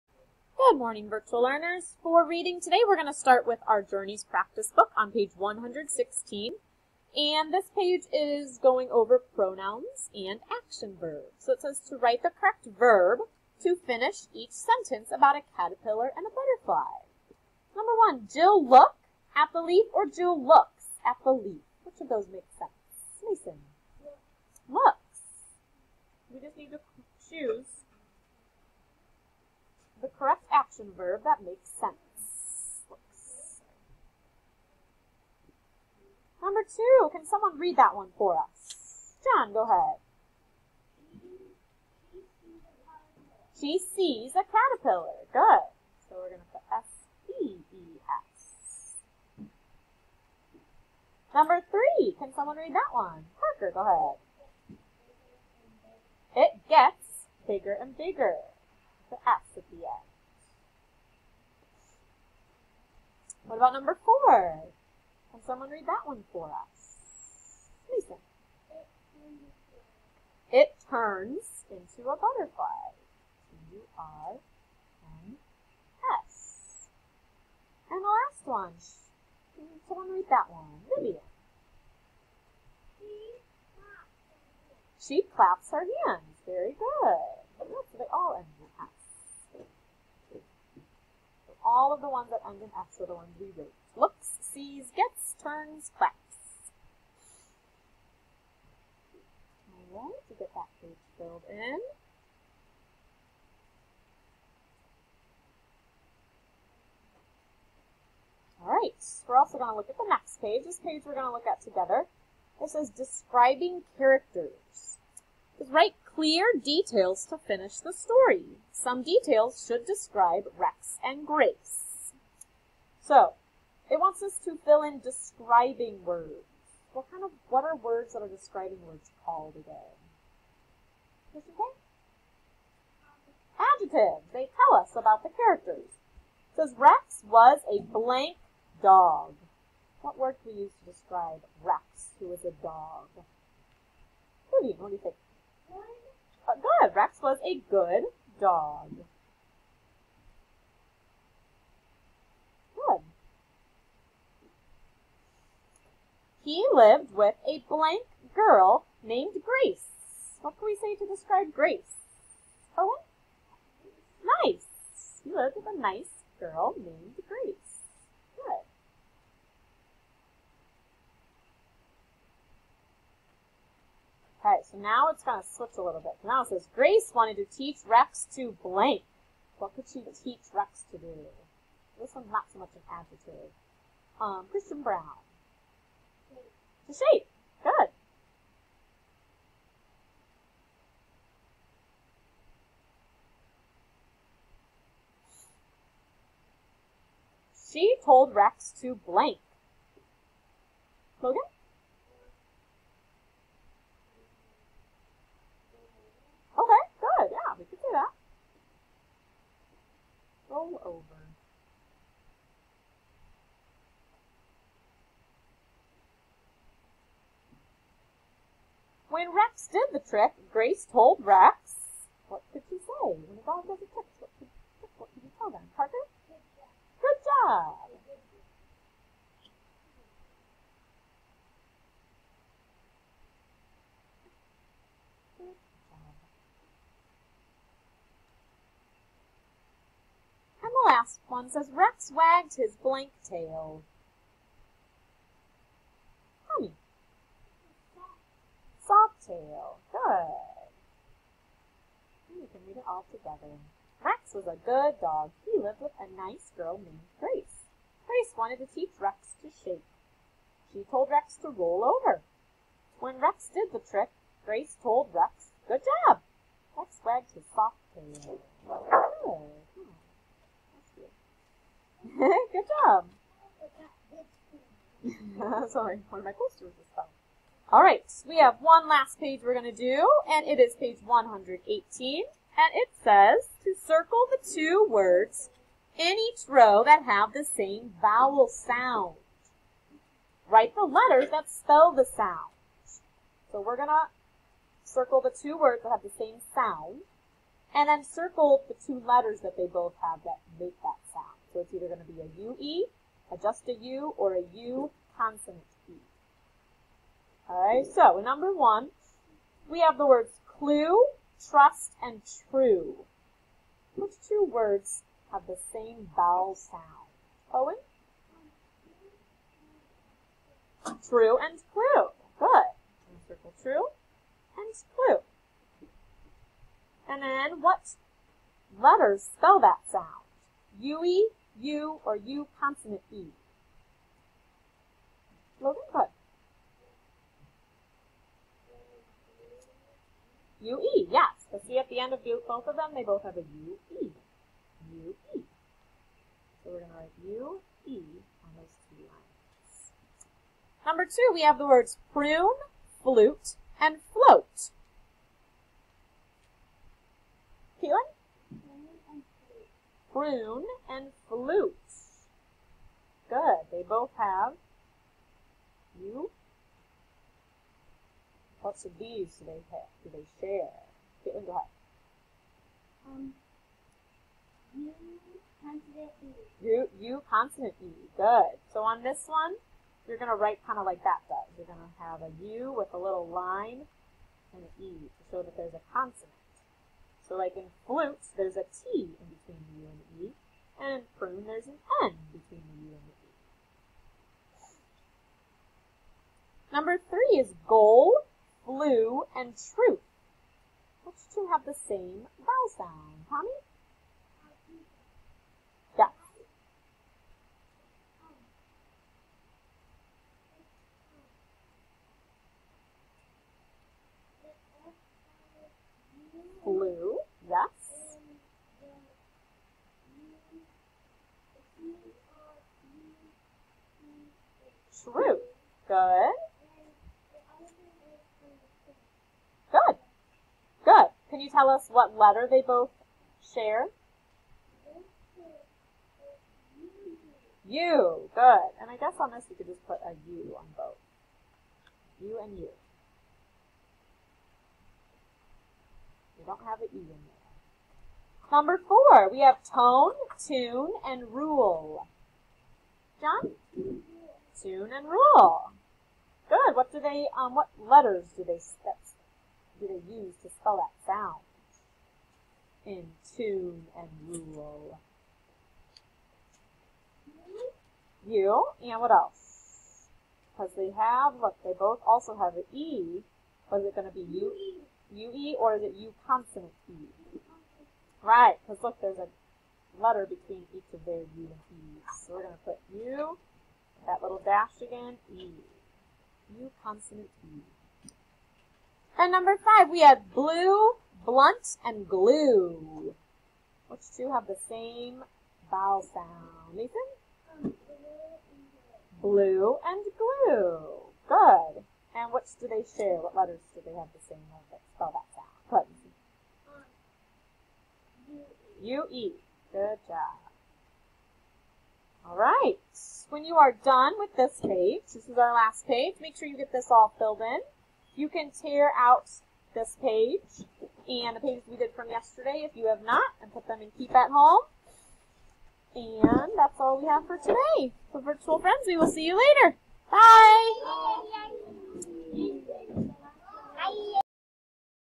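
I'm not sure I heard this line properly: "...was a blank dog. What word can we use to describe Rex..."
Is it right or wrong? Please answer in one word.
right.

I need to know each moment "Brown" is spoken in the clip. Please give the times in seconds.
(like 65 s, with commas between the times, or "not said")
184 s.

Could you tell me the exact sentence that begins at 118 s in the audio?
Some details should describe Rex and Grace.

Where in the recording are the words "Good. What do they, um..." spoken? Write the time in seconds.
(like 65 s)
456 s.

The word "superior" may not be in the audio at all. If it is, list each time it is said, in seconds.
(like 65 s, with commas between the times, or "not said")
not said.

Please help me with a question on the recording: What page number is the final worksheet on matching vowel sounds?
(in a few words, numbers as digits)
118.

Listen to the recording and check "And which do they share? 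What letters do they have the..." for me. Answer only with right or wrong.
right.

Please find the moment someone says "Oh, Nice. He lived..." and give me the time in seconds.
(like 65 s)
162 s.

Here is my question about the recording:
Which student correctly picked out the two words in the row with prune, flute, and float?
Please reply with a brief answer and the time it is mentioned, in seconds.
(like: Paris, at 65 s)
Keelan, at 357 s.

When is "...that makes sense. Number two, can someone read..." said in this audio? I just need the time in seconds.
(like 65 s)
31 s.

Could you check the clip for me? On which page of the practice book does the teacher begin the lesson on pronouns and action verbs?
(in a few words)
116.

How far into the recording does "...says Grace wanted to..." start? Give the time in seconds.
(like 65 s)
176 s.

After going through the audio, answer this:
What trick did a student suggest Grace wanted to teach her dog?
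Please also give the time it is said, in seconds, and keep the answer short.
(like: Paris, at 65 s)
Shake, at 186 s.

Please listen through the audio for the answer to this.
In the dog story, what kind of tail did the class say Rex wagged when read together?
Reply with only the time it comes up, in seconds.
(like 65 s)
267 s.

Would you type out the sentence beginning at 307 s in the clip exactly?
Okay, so in number one, we have the words clue, trust, and true.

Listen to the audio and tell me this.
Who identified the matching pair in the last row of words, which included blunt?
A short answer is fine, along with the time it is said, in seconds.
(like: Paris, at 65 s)
Nathan, at 496 s.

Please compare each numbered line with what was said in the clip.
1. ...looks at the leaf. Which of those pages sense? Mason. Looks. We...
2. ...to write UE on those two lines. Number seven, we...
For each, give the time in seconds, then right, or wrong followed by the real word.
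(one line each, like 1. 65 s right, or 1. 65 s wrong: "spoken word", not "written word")
1. 20 s wrong: "makes", not "pages"
2. 346 s wrong: "two", not "seven".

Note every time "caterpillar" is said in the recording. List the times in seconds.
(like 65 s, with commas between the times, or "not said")
15 s, 44 s.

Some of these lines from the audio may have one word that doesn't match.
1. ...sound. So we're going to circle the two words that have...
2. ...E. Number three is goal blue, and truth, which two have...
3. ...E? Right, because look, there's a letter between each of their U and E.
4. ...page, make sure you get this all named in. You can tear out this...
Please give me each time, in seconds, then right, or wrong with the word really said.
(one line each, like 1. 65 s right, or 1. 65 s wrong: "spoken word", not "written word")
1. 292 s right
2. 393 s right
3. 476 s right
4. 515 s wrong: "filled", not "named".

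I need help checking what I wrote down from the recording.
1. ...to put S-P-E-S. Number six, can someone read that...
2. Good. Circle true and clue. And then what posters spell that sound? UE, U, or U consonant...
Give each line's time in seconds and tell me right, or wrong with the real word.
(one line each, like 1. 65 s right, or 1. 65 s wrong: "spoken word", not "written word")
1. 46 s wrong: "three", not "six"
2. 322 s wrong: "letters", not "posters".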